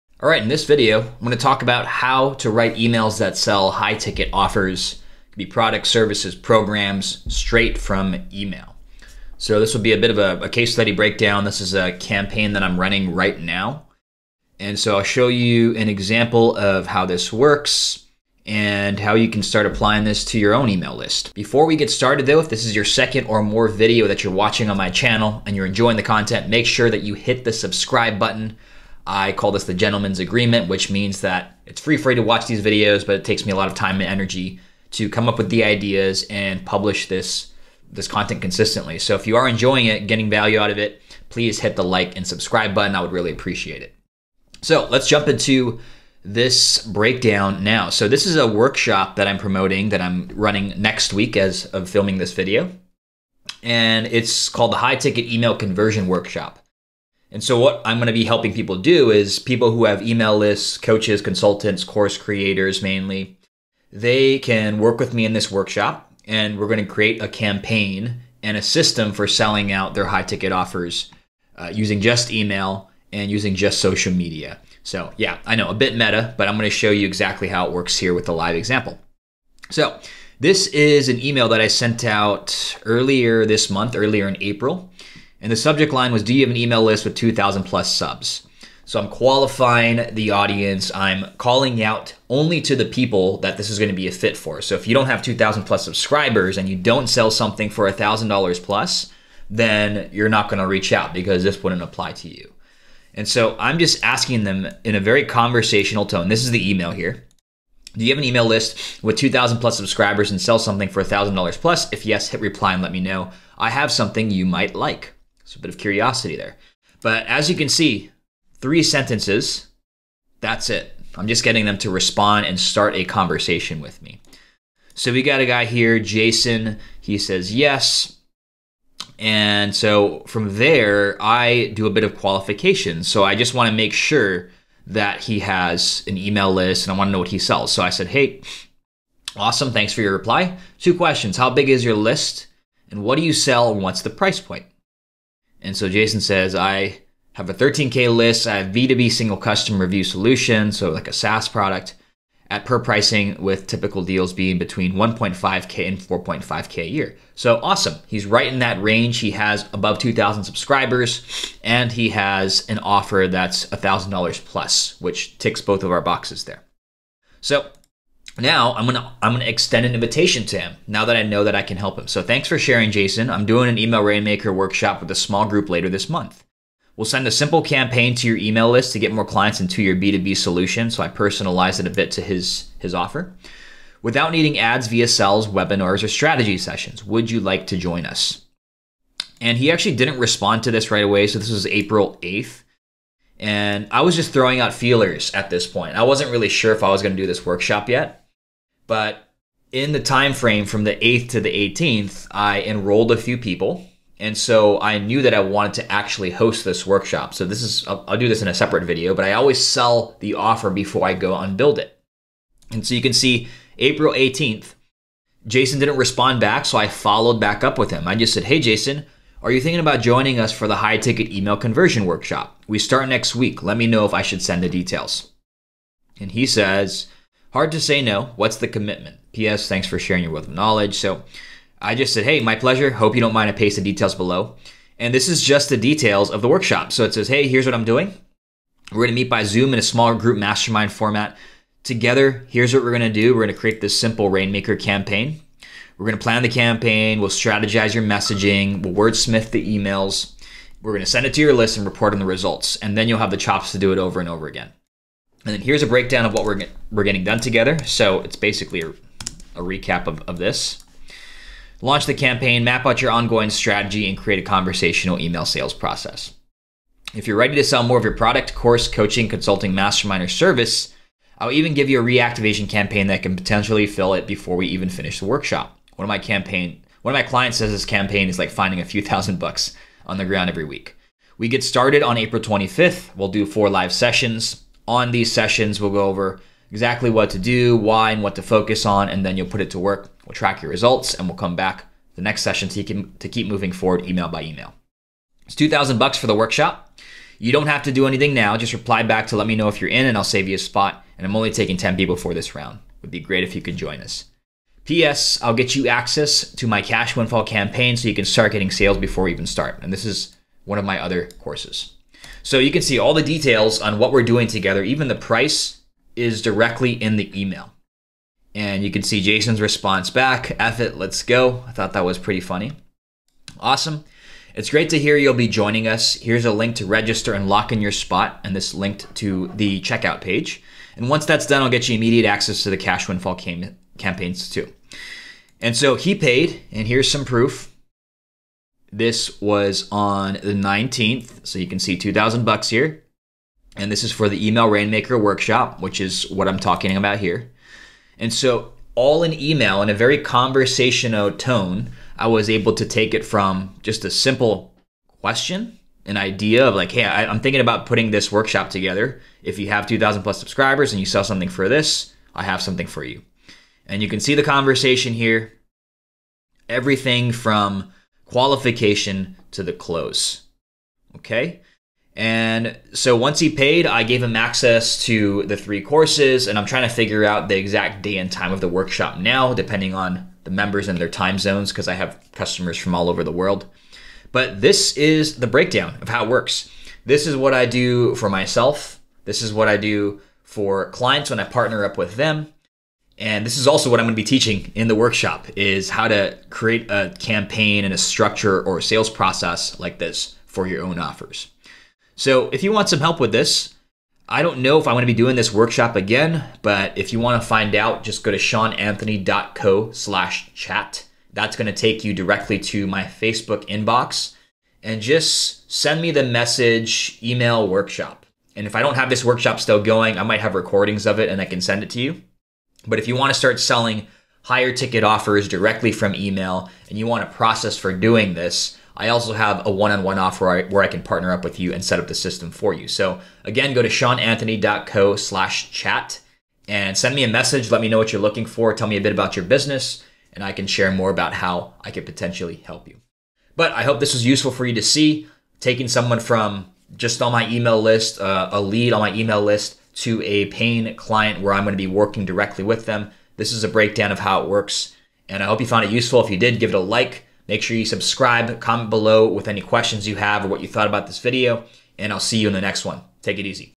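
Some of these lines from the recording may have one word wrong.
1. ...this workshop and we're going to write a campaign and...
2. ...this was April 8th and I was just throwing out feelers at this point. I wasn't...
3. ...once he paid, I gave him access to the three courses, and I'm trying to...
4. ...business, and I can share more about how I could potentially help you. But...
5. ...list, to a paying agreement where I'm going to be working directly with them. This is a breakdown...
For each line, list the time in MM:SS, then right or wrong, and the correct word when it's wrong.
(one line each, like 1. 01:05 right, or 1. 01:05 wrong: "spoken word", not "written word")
1. 01:05 wrong: "create", not "write"
2. 03:11 right
3. 06:13 right
4. 07:19 right
5. 07:29 wrong: "client", not "agreement".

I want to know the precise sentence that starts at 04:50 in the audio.
We'll track your results, and we'll come back the next session to keep, to keep moving forward email by email.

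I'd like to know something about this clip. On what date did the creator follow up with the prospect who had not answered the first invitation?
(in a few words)
April 18th.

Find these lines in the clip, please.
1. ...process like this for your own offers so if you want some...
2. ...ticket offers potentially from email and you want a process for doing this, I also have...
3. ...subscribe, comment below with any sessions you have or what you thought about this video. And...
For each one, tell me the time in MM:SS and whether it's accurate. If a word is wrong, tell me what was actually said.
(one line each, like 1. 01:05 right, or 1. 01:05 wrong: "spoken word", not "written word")
1. 06:39 right
2. 07:04 wrong: "directly", not "potentially"
3. 07:37 wrong: "questions", not "sessions".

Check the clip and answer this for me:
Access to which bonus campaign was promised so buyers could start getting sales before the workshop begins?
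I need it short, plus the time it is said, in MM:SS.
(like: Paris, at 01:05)
cash windfall campaign, at 05:06.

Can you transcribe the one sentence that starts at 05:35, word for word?
And so he paid, and here's some proof.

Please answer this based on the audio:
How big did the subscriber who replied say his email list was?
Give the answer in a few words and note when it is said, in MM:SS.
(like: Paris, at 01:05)
13K, at 02:27.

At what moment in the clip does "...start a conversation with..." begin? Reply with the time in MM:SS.
02:02.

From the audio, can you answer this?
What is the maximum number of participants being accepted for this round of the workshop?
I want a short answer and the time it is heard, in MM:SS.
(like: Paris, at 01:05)
10, at 05:01.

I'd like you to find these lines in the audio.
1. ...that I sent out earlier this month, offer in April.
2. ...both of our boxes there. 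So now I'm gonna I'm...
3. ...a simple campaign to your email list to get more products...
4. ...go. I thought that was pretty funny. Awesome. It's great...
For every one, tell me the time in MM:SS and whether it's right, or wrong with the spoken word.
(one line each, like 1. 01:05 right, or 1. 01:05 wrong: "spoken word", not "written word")
1. 01:21 wrong: "earlier", not "offer"
2. 02:45 right
3. 02:57 wrong: "clients", not "products"
4. 05:21 right.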